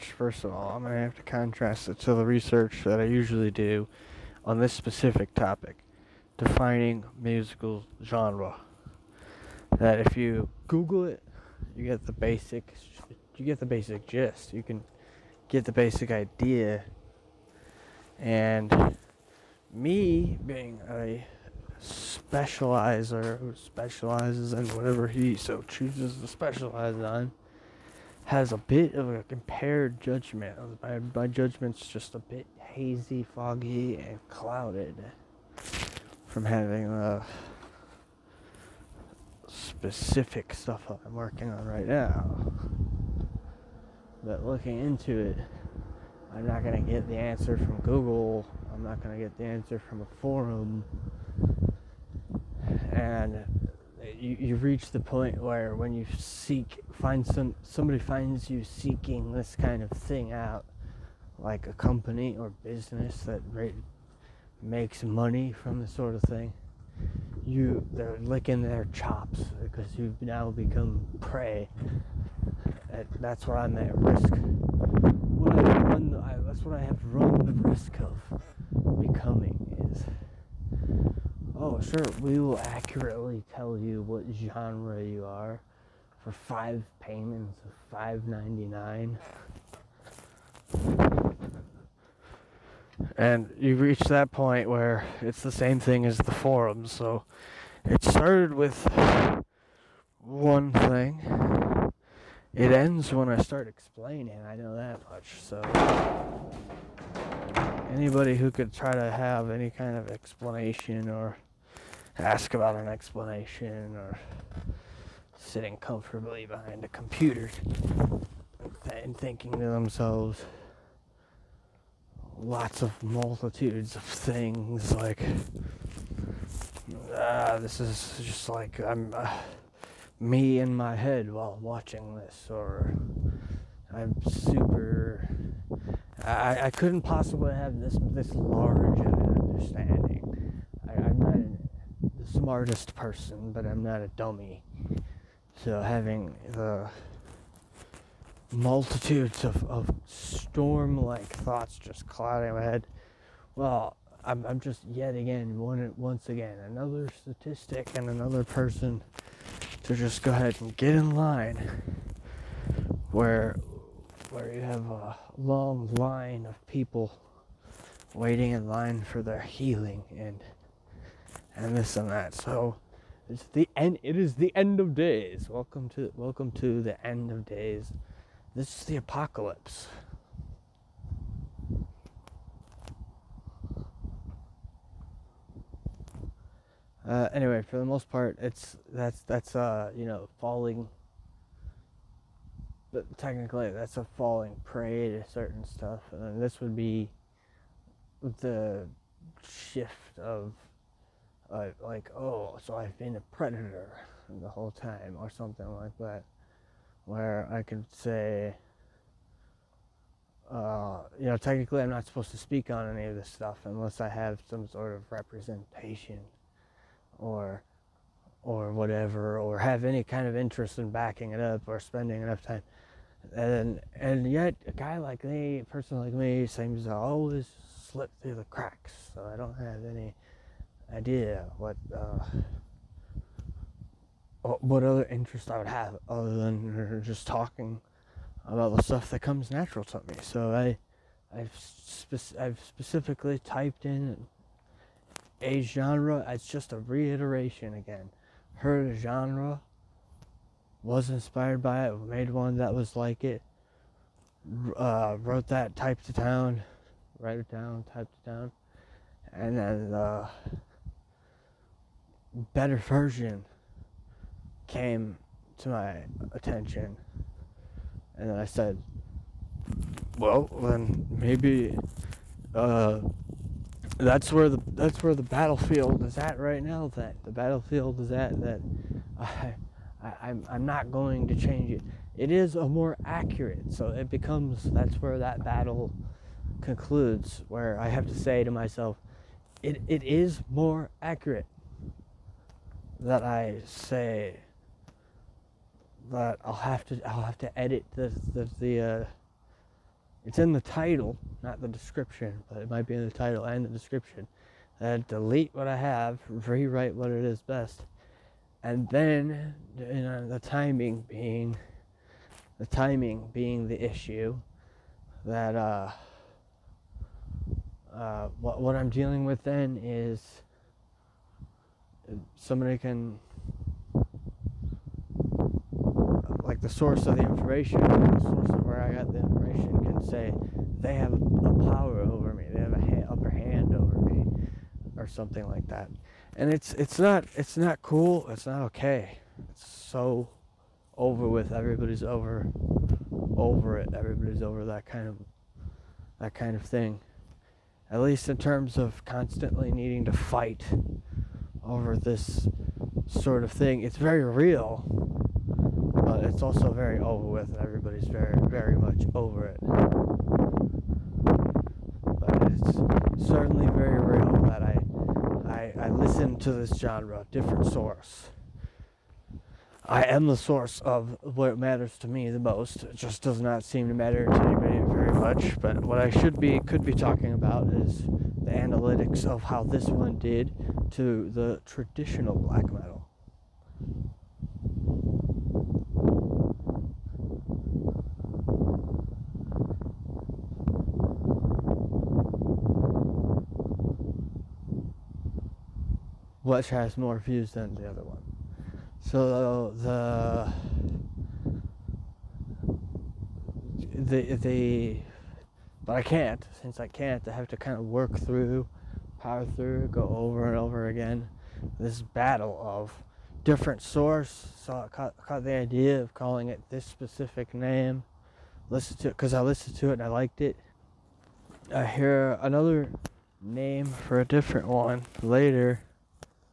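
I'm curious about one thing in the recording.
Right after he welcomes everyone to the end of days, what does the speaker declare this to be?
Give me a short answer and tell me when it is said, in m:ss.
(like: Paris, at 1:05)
the apocalypse, at 2:58.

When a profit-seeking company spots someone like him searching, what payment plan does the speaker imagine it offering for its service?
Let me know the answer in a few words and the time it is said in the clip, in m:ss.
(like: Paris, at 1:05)
5 payments of $5.99, at 1:26.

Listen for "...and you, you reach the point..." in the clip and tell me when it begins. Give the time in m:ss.
0:53.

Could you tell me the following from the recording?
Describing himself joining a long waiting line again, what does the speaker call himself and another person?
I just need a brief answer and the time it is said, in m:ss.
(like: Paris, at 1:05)
another statistic, at 2:36.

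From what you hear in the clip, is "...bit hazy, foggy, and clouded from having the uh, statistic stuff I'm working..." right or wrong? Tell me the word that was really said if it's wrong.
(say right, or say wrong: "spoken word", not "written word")
wrong: "specific", not "statistic".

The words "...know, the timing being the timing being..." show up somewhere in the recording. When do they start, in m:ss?
5:09.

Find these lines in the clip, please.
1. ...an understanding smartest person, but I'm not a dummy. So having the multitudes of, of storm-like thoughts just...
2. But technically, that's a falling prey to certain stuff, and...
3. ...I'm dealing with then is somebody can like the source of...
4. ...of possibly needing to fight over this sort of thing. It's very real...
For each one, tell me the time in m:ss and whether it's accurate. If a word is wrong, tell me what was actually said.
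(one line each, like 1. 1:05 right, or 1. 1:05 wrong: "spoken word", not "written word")
1. 2:18 right
2. 3:12 right
3. 5:18 right
4. 5:48 wrong: "constantly", not "possibly".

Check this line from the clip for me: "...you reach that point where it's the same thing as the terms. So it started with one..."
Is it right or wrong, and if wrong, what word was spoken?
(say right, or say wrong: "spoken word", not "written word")
wrong: "forums", not "terms".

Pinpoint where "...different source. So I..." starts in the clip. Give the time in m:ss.
6:53.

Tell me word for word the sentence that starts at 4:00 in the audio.
So I I've spe- I've specifically typed in a genre.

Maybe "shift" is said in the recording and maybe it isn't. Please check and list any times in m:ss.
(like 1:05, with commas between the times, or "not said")
3:19.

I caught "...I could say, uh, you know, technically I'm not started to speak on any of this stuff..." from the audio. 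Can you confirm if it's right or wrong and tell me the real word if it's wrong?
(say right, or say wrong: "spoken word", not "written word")
wrong: "supposed", not "started".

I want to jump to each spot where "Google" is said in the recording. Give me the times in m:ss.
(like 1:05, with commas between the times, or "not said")
0:10, 0:47.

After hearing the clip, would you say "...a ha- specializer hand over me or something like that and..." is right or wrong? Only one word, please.
wrong.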